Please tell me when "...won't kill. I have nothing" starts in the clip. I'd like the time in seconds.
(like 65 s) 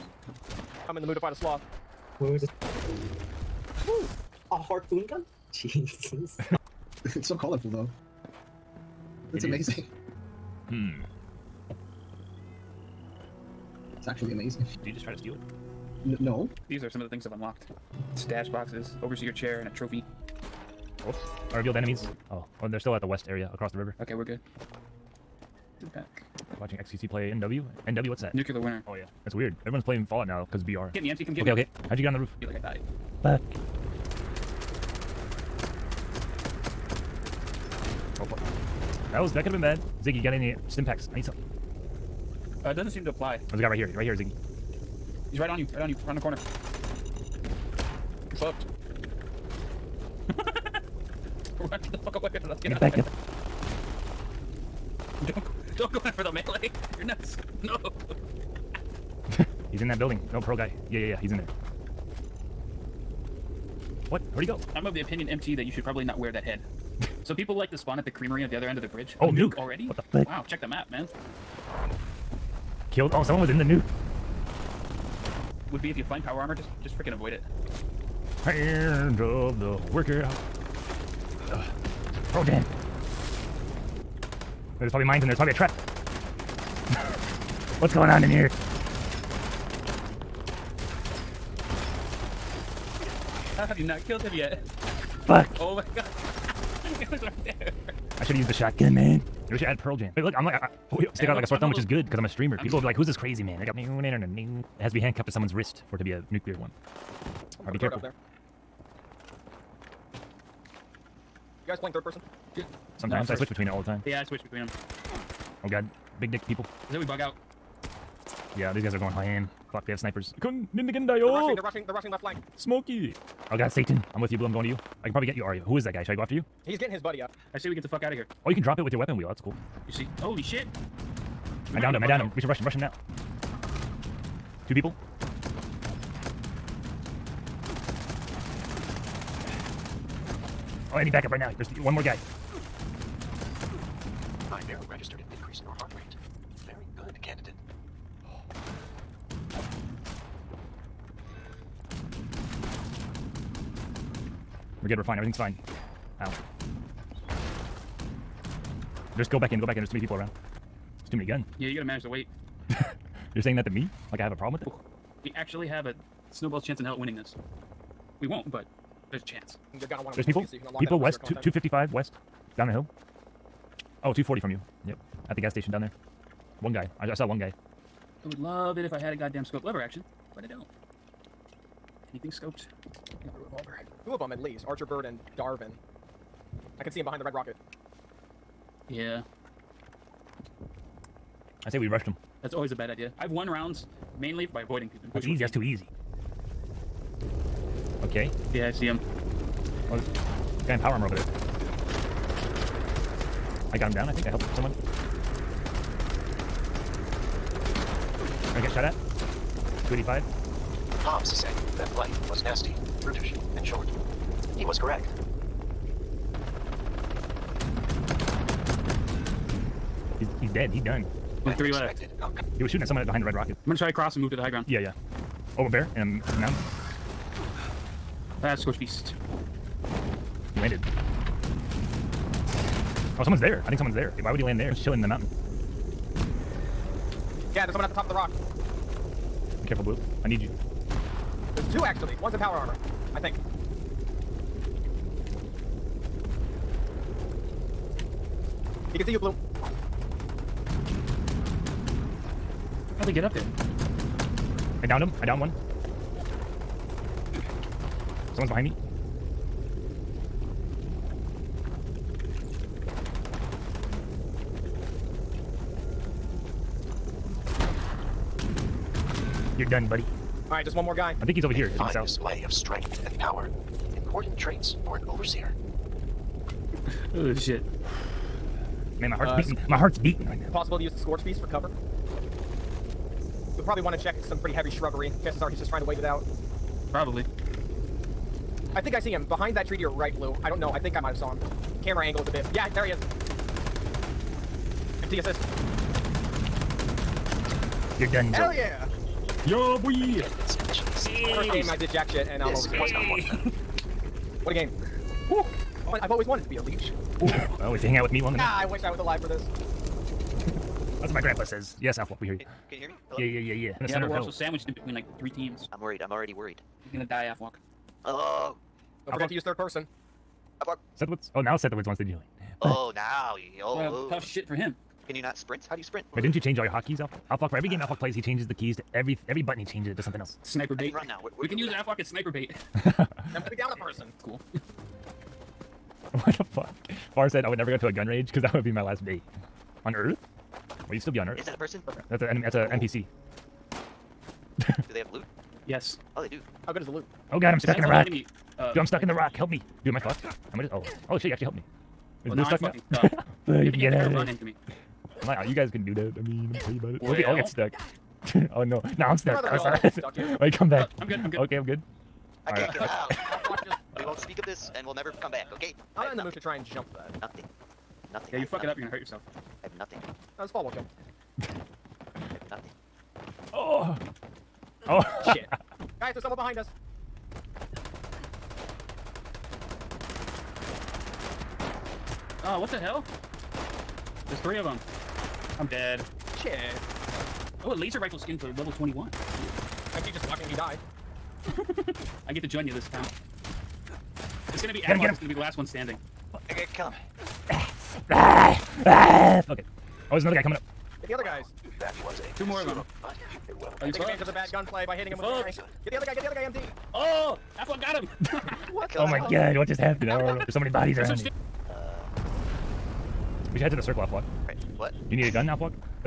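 370 s.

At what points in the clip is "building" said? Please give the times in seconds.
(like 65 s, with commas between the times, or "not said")
59 s.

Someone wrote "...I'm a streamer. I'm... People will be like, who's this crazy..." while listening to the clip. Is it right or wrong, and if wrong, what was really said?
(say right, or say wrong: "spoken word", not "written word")
right.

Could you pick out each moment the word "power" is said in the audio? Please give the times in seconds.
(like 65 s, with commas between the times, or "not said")
76 s, 200 s, 242 s, 273 s.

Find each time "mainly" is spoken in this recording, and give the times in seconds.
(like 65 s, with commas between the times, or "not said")
194 s.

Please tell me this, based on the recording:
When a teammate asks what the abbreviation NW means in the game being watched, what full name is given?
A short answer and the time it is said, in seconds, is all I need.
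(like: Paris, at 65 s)
Nuclear Winter, at 28 s.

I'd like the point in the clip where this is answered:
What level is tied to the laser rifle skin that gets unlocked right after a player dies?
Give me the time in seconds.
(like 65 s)
388 s.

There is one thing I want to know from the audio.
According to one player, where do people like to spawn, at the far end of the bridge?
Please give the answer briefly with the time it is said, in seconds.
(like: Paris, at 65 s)
the creamery, at 68 s.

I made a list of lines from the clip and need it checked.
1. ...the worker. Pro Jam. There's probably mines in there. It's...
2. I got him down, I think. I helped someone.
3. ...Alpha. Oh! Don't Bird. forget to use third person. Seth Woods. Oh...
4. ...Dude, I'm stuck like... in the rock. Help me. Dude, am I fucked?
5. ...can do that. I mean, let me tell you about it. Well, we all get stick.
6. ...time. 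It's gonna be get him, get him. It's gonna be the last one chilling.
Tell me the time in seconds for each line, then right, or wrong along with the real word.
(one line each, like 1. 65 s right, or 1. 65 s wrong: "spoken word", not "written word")
1. 79 s right
2. 203 s right
3. 317 s wrong: "Alpha", not "Bird"
4. 348 s right
5. 355 s wrong: "stuck", not "stick"
6. 392 s wrong: "standing", not "chilling".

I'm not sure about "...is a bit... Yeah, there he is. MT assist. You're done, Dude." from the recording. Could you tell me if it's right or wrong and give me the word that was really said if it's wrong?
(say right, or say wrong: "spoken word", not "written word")
wrong: "Joe", not "Dude".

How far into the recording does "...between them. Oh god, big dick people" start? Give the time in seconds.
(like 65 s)
114 s.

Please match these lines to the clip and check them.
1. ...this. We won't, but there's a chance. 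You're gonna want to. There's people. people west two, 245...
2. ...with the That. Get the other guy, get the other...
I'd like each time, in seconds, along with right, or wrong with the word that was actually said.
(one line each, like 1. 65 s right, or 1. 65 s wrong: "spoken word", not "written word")
1. 167 s wrong: "255", not "245"
2. 405 s wrong: "Mary", not "That".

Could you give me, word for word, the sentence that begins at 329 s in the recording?
He changes it to something else.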